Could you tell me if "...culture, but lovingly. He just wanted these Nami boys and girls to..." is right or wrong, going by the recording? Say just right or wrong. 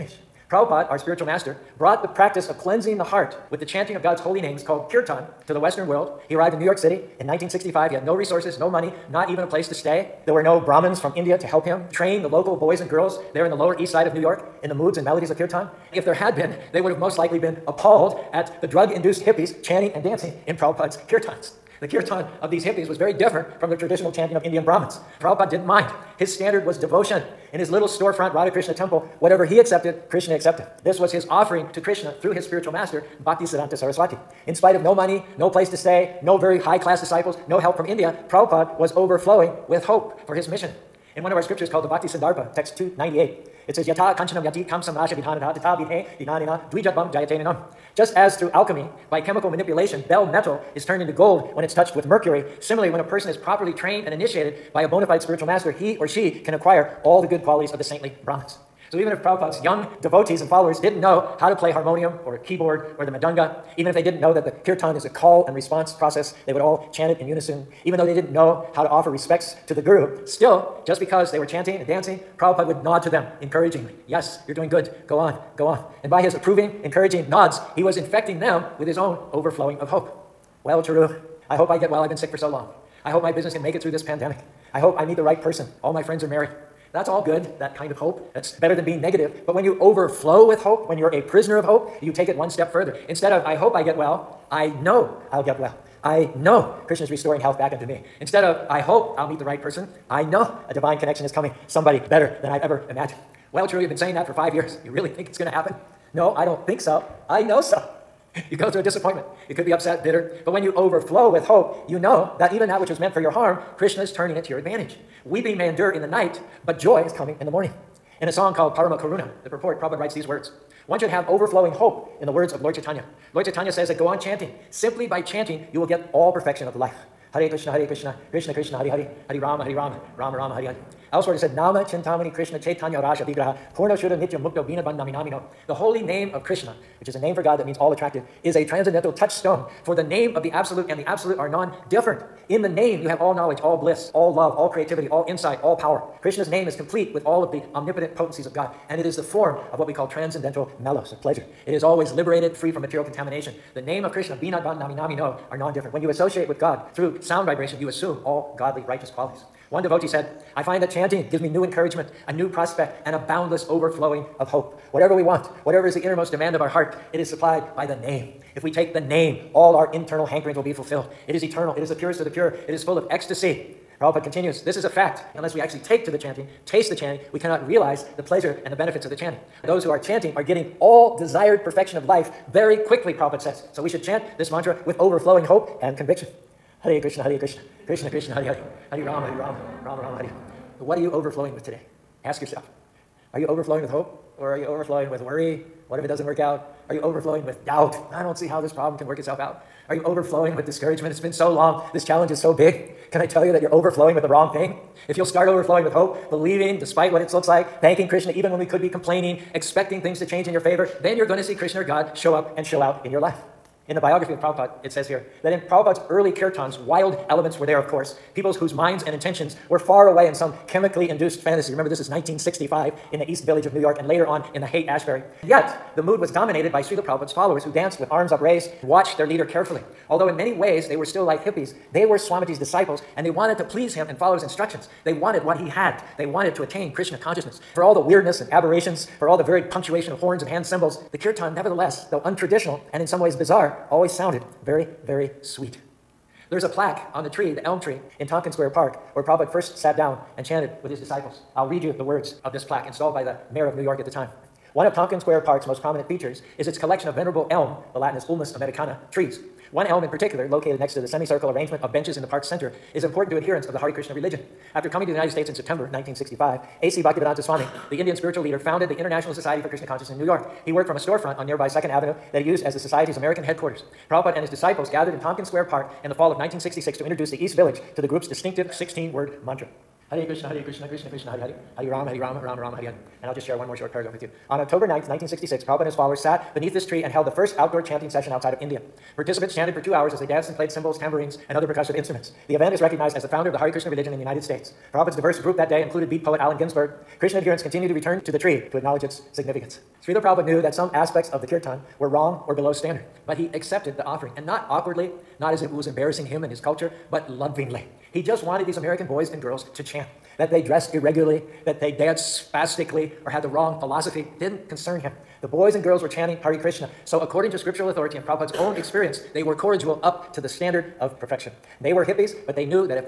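wrong.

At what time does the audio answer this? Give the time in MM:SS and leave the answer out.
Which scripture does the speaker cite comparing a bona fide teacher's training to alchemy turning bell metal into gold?
00:41.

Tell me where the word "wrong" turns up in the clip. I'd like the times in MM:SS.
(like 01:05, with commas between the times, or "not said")
03:24, 05:02, 05:13.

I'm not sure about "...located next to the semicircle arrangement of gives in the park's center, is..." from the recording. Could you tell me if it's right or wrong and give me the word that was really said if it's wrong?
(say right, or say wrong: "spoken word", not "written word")
wrong: "benches", not "gives".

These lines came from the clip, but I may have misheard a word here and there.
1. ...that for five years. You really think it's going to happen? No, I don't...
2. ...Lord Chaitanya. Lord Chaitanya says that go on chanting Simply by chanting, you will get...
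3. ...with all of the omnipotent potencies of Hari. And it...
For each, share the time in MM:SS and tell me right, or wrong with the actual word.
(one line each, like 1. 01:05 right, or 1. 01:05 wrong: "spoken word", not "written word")
1. 01:44 right
2. 02:02 right
3. 02:27 wrong: "God", not "Hari".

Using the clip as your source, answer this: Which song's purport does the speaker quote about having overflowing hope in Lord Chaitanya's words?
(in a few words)
Parama Karuna.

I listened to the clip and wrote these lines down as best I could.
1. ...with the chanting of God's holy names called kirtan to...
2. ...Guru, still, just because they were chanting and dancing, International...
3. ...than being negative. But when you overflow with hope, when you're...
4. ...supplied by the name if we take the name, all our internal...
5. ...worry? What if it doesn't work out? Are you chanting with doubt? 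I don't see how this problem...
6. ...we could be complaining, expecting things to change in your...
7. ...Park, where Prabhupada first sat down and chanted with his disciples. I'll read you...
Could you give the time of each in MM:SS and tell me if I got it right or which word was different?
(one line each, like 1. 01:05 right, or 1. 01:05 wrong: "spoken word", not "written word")
1. 00:03 right
2. 01:09 wrong: "Prabhupada", not "International"
3. 01:28 right
4. 02:47 right
5. 03:15 wrong: "overflowing", not "chanting"
6. 03:28 right
7. 04:08 right.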